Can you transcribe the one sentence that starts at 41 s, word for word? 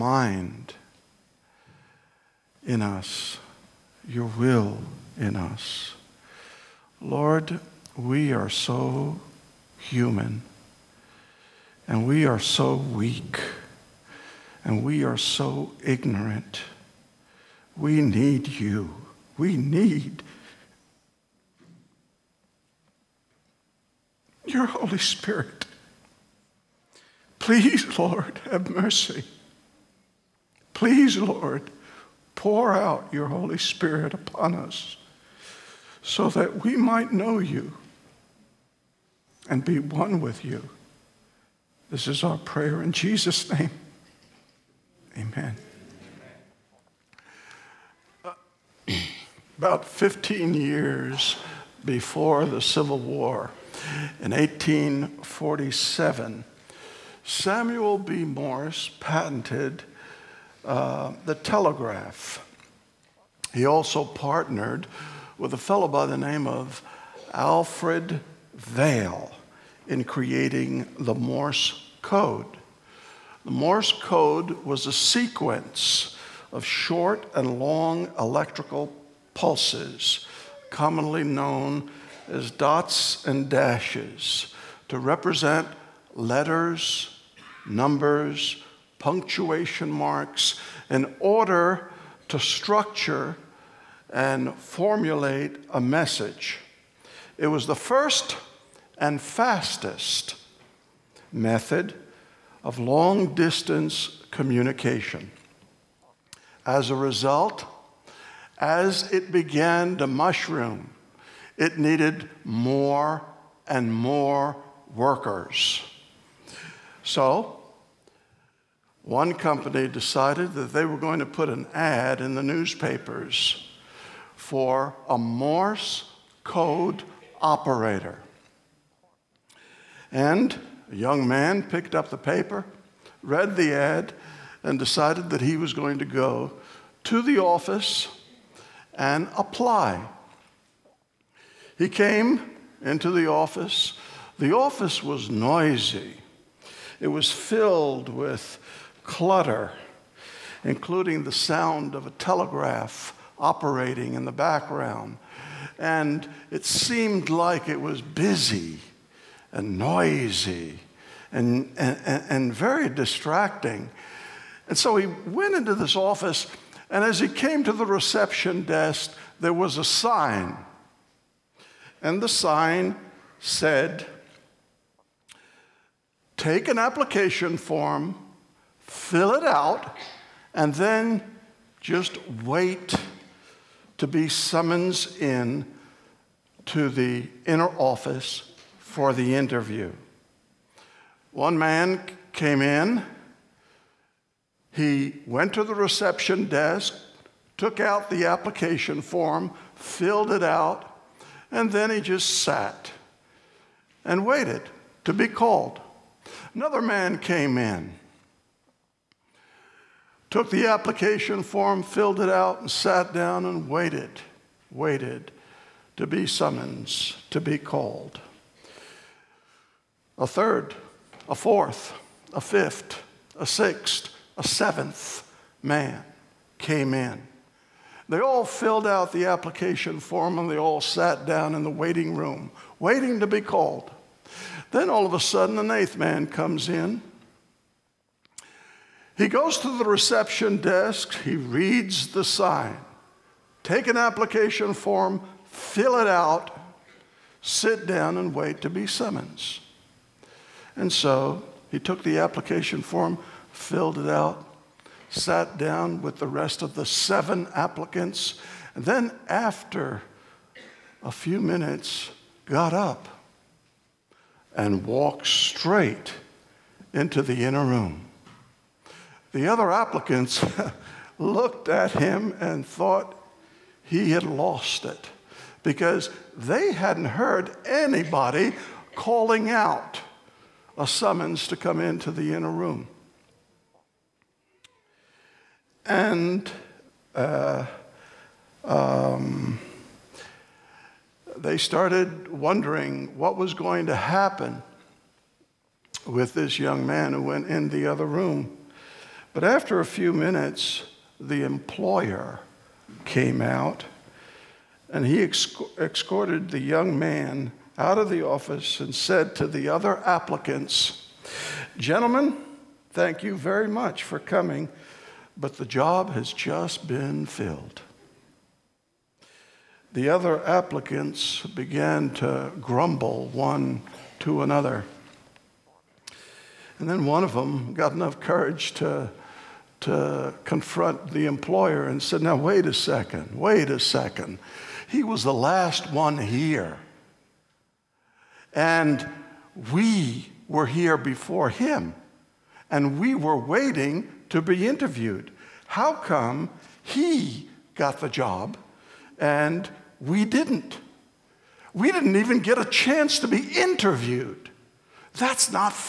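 This is our prayer in Jesus' name.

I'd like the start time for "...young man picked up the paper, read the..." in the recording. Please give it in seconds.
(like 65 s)
130 s.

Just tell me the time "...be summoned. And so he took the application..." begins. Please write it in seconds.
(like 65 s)
248 s.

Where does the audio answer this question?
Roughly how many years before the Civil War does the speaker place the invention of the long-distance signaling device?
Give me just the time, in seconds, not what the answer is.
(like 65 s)
49 s.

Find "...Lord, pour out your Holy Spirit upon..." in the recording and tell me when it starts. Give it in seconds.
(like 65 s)
31 s.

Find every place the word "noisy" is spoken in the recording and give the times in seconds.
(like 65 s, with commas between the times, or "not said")
145 s, 159 s.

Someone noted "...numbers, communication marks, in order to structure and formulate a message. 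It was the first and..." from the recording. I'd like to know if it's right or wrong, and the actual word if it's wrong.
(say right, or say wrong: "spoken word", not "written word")
wrong: "punctuation", not "communication".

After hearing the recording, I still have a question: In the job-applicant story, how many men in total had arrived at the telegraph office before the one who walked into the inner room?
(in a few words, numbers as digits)
7.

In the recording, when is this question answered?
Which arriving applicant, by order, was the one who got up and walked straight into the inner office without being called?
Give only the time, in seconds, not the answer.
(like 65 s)
235 s.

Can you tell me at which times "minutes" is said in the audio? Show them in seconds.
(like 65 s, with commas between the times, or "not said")
261 s, 300 s.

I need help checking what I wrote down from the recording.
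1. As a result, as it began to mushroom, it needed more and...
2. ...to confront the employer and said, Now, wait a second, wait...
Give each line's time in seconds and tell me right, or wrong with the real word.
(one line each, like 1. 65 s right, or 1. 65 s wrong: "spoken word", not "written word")
1. 106 s right
2. 329 s right.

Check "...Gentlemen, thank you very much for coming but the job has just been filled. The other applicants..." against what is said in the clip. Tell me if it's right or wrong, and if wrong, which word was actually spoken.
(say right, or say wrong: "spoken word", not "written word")
right.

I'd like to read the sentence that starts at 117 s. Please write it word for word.
So, one company decided that they were going to put an ad in the newspapers for a Morse code operator.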